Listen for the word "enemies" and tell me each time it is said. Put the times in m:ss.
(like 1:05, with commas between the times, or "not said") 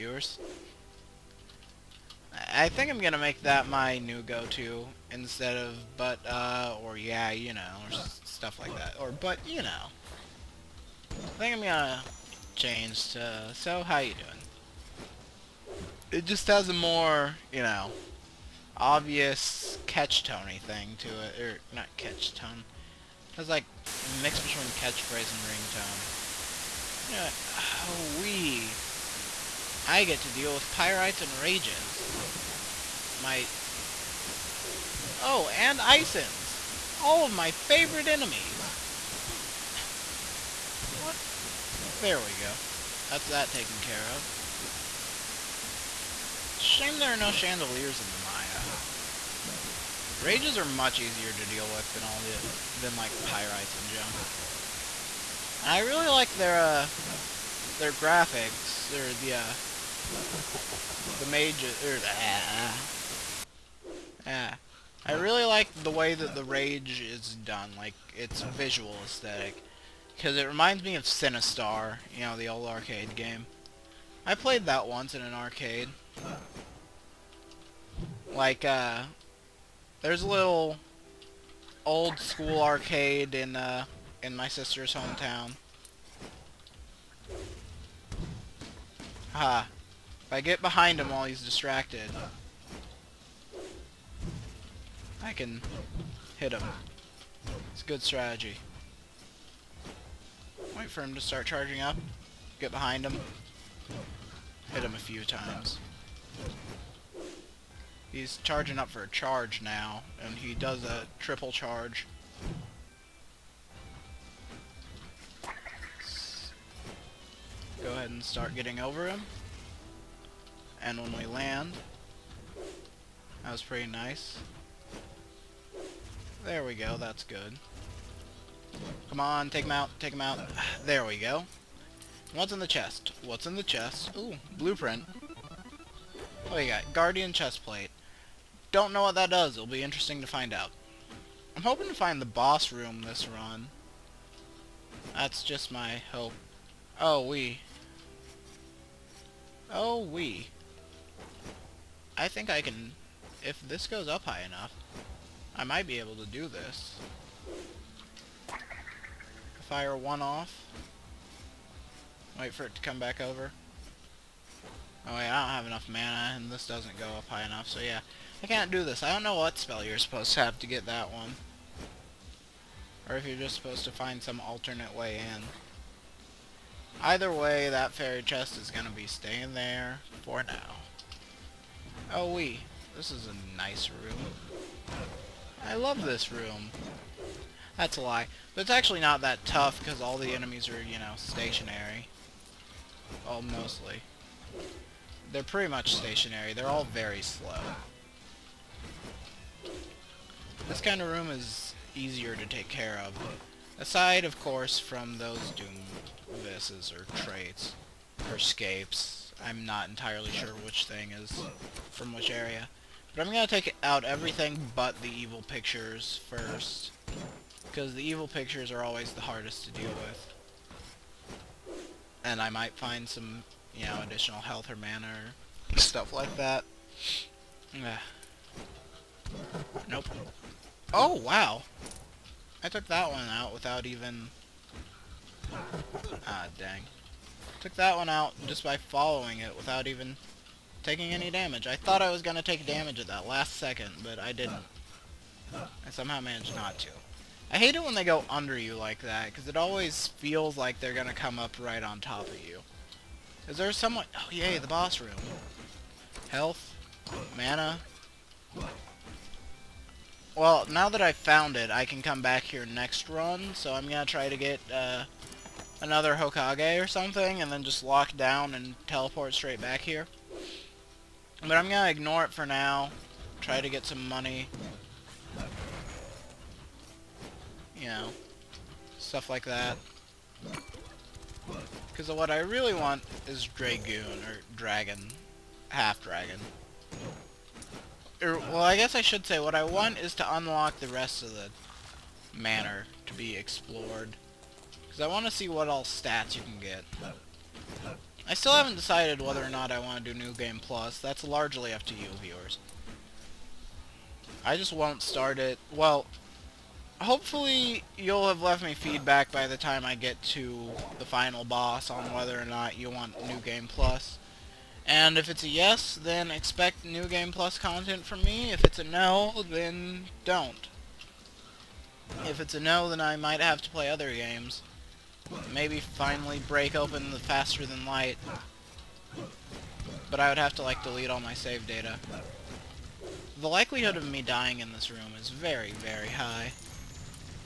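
0:38, 3:10.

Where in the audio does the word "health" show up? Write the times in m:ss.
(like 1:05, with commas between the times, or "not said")
3:44, 4:16.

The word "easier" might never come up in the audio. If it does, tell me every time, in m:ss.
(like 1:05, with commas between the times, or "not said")
0:51, 3:21.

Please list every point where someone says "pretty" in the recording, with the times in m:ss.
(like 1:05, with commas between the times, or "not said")
2:03, 3:15.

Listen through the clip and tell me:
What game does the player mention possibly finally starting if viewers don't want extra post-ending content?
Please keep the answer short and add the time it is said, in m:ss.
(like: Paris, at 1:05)
Faster Than Light, at 5:27.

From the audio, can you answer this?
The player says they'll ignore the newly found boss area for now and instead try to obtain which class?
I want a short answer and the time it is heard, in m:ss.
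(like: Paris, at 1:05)
Half-Dragon, at 4:45.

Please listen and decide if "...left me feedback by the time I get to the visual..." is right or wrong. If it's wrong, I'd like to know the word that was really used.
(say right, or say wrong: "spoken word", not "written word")
wrong: "final", not "visual".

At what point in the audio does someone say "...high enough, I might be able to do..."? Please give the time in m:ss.
2:34.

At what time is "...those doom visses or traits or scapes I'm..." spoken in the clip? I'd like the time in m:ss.
3:25.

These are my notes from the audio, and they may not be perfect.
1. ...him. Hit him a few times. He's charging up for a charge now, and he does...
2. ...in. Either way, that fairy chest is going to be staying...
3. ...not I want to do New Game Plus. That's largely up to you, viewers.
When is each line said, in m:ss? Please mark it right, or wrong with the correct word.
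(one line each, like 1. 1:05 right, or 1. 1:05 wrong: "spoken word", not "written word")
1. 1:43 right
2. 2:55 right
3. 4:59 right.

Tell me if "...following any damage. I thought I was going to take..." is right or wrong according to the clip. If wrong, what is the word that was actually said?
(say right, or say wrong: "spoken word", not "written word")
wrong: "taking", not "following".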